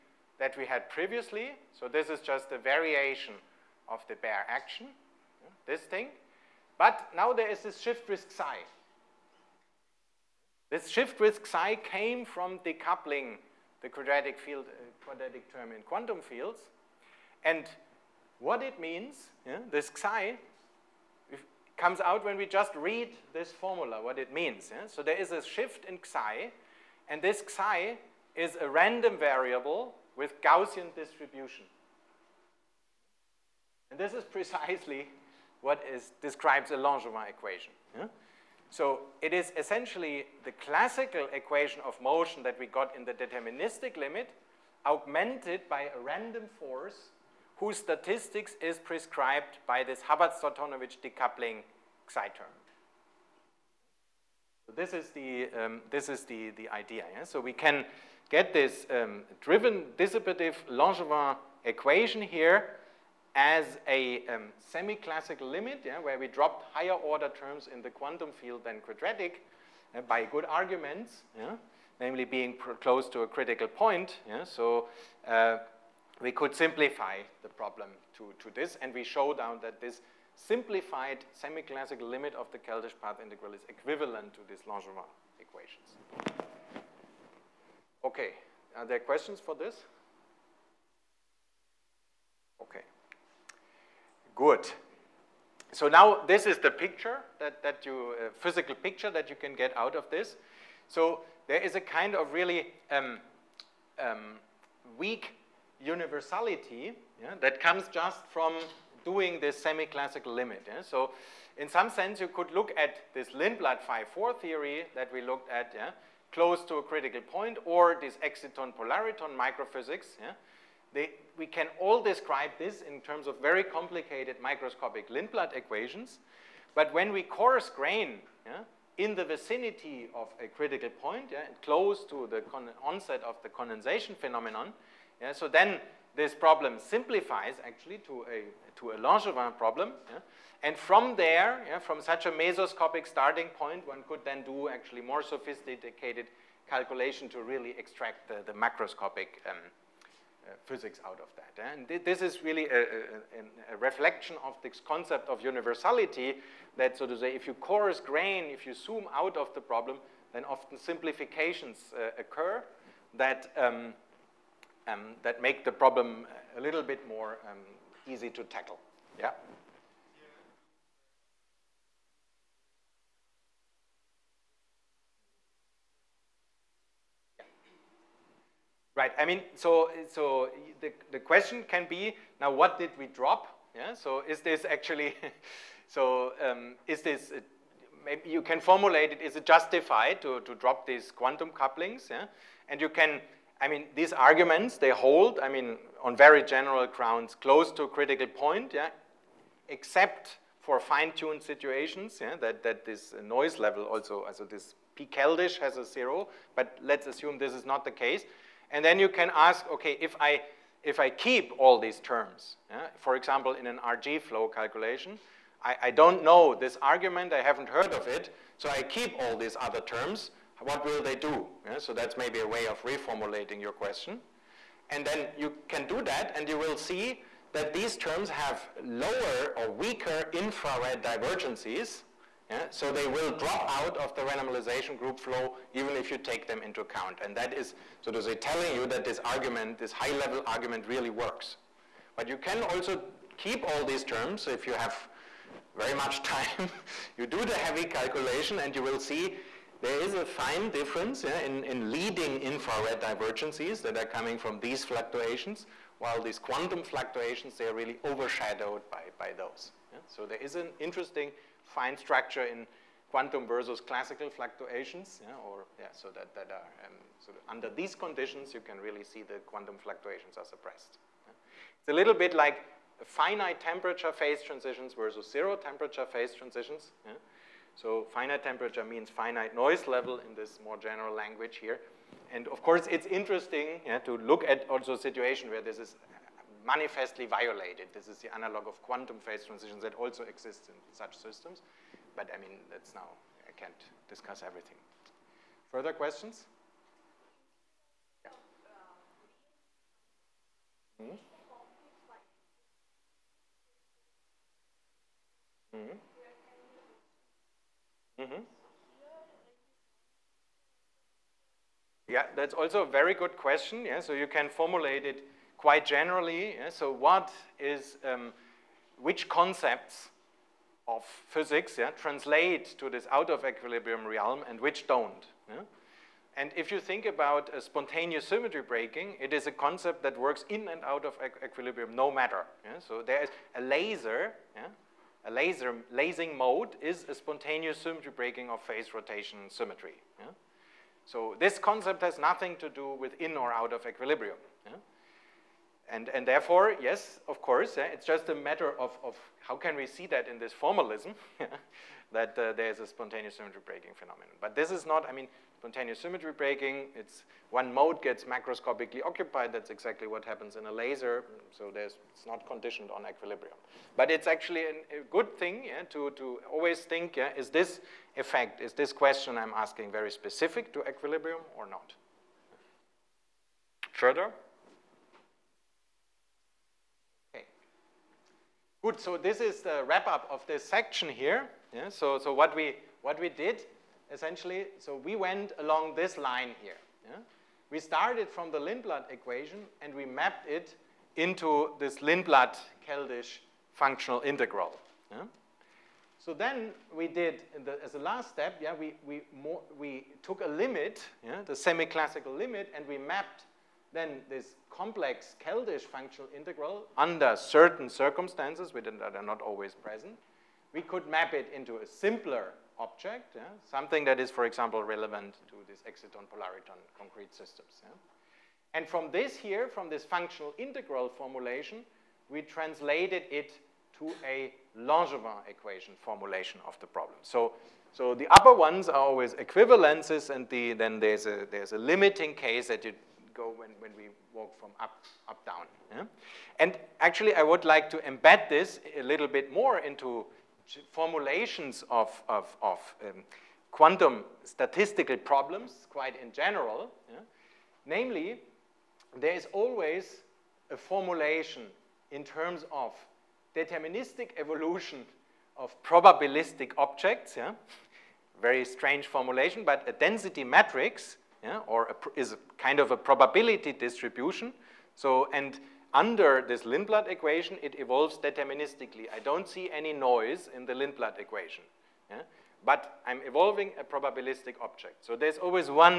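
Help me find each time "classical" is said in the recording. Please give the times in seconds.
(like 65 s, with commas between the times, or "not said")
40 s, 64 s, 81 s, 109 s, 263 s, 401 s.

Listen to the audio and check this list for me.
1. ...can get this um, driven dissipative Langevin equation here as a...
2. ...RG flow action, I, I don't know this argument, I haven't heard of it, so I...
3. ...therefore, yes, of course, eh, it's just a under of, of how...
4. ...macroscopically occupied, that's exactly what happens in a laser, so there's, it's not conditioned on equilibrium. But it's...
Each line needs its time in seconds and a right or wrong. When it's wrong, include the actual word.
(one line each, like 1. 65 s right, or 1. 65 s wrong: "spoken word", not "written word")
1. 57 s right
2. 213 s wrong: "calculation", not "action"
3. 346 s wrong: "matter", not "under"
4. 358 s right.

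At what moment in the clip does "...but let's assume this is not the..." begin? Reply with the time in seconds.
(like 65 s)
206 s.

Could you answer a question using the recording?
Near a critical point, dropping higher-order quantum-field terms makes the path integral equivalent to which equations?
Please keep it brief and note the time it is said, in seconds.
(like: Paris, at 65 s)
Langevin equations, at 84 s.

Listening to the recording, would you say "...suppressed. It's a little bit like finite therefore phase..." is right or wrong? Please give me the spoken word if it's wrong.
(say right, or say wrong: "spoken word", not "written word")
wrong: "temperature", not "therefore".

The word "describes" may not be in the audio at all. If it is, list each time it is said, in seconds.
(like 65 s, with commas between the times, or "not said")
36 s, 122 s.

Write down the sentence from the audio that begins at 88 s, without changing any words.
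Okay, are there questions for this?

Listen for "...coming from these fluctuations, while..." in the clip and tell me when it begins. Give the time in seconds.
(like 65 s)
254 s.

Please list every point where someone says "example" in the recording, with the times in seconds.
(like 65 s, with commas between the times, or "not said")
213 s, 414 s.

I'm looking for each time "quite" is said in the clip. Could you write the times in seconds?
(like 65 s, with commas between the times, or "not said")
315 s, 445 s.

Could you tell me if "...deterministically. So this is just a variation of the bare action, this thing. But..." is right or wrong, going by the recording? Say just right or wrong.
wrong.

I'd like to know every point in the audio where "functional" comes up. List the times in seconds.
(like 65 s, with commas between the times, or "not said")
393 s, 405 s, 420 s.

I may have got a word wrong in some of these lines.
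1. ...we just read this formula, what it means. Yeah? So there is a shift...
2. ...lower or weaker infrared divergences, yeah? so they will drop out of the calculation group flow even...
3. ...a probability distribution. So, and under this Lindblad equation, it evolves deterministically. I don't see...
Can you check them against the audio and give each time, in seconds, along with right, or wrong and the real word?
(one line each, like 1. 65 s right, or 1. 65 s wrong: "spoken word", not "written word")
1. 22 s right
2. 228 s wrong: "renormalization", not "calculation"
3. 462 s right.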